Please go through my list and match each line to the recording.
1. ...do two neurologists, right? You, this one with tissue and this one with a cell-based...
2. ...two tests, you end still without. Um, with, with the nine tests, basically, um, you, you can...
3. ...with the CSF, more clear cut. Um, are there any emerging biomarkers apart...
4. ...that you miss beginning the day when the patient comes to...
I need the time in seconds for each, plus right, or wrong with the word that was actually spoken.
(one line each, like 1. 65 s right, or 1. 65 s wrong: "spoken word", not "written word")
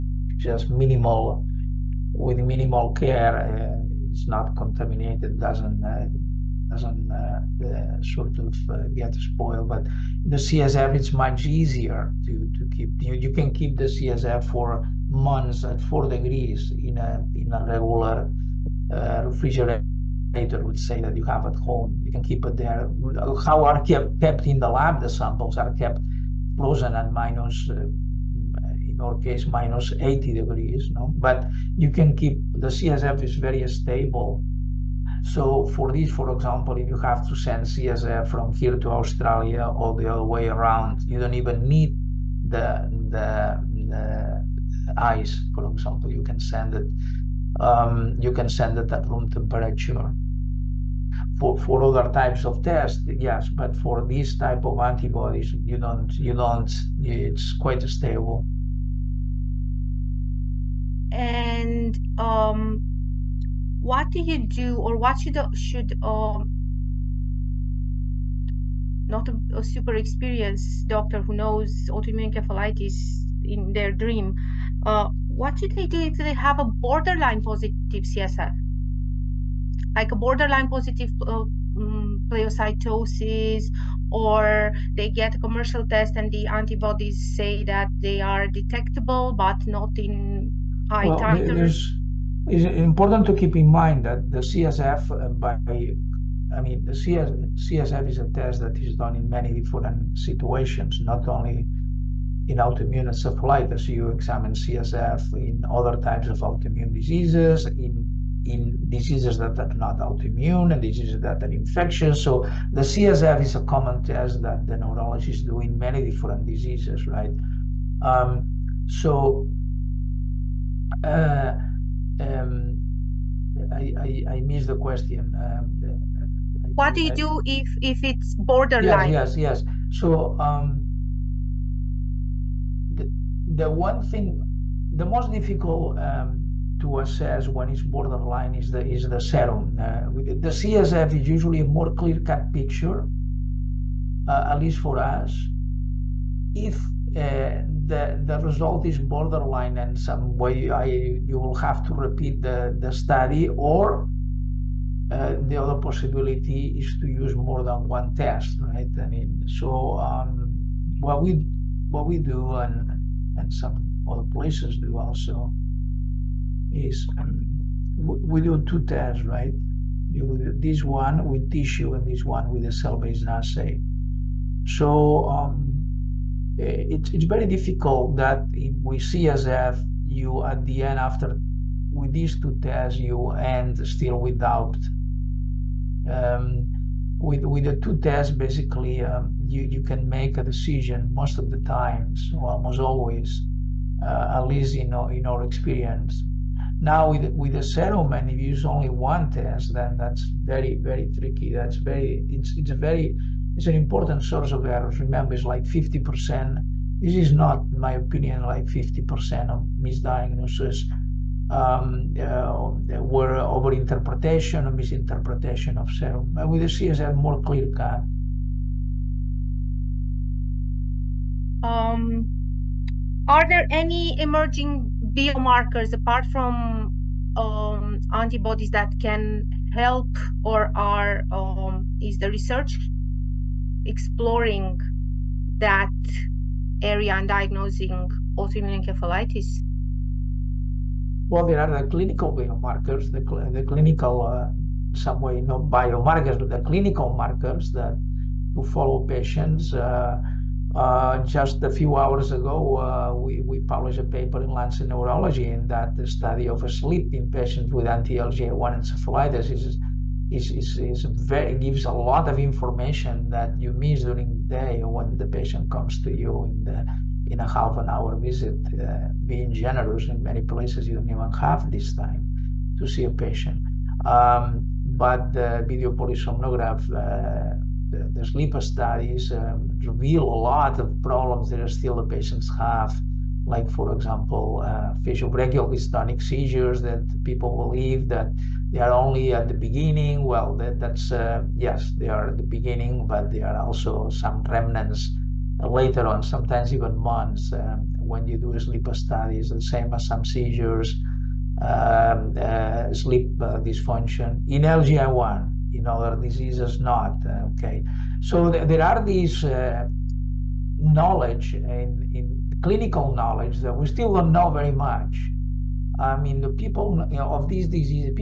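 1. 168 s wrong: "tests", not "neurologists"
2. 182 s wrong: "two", not "nine"
3. 216 s right
4. 263 s wrong: "during", not "beginning".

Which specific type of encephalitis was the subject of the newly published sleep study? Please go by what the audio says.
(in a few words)
anti-LGI1 encephalitis.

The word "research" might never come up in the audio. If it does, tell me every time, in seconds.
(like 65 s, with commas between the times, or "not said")
232 s.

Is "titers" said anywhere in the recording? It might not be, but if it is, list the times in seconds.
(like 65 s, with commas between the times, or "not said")
91 s.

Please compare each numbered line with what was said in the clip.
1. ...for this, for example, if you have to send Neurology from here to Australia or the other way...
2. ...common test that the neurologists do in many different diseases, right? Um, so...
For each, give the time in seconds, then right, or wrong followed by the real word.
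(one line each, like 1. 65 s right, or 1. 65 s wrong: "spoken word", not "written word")
1. 35 s wrong: "CSF", not "Neurology"
2. 113 s right.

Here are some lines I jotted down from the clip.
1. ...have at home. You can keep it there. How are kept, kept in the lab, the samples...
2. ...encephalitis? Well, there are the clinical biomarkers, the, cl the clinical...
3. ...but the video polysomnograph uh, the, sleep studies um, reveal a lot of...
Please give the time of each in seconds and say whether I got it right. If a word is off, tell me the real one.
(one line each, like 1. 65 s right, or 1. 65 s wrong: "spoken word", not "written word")
1. 21 s right
2. 238 s right
3. 274 s right.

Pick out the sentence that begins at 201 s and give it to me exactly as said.
That's very, it's, it's a very, it's an important source of errors.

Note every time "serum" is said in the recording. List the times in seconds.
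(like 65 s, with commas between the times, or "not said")
139 s, 197 s, 215 s.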